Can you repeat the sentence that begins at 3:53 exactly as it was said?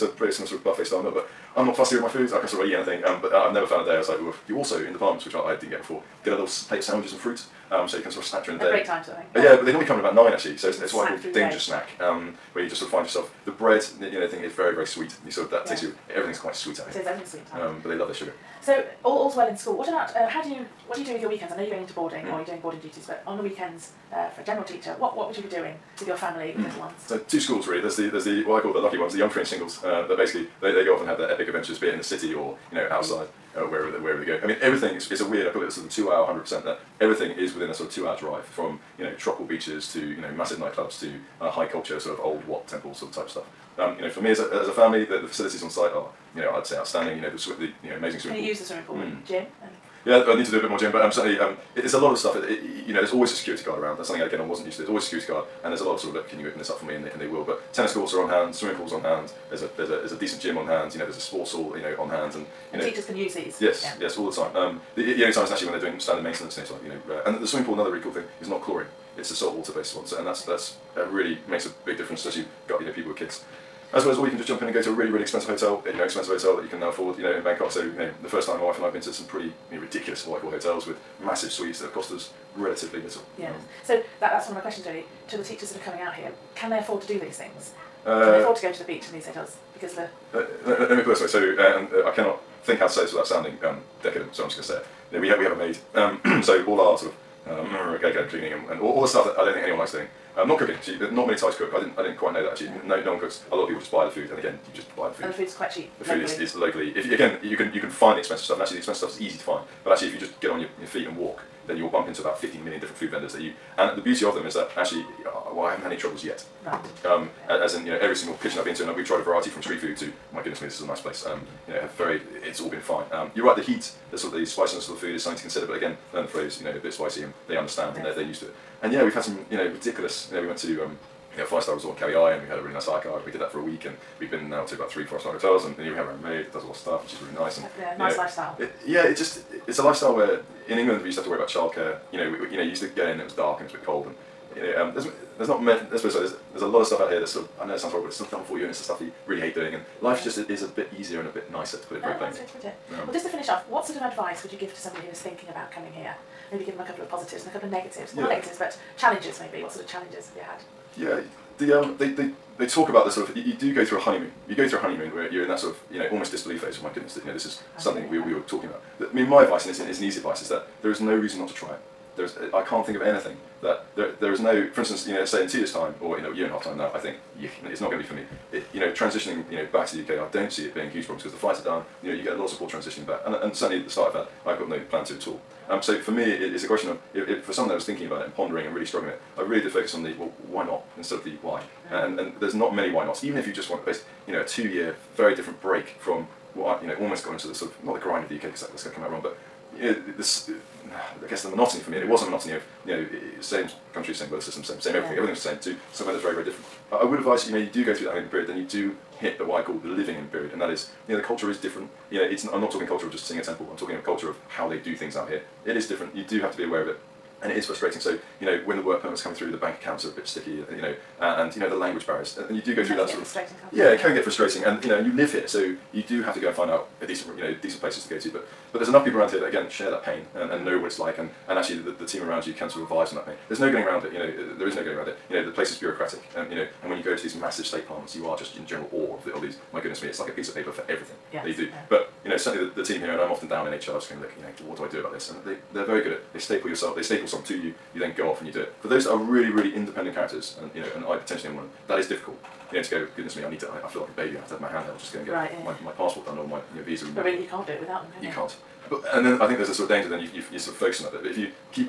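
There's no getting around it, you know, there is no getting around it.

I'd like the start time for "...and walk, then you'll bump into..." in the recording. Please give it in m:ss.
1:51.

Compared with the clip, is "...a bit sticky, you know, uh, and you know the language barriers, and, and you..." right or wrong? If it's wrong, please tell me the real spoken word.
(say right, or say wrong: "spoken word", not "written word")
right.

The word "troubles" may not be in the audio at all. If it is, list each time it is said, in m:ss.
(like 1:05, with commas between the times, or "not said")
1:55.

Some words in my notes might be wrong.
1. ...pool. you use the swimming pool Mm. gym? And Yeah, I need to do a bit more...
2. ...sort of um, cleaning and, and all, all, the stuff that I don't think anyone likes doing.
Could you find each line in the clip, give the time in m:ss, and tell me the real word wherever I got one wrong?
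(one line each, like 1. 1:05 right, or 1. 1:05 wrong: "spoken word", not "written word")
1. 0:48 right
2. 1:36 right.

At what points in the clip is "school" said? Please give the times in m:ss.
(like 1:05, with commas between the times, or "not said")
0:19, 0:27.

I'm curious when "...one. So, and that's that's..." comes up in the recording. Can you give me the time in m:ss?
1:09.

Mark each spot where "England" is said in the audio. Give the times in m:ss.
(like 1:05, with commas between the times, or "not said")
2:20.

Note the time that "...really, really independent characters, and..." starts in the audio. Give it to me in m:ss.
4:09.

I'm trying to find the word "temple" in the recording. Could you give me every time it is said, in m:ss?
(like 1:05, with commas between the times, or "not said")
0:42, 3:33.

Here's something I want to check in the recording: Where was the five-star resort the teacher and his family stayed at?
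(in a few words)
Kauai.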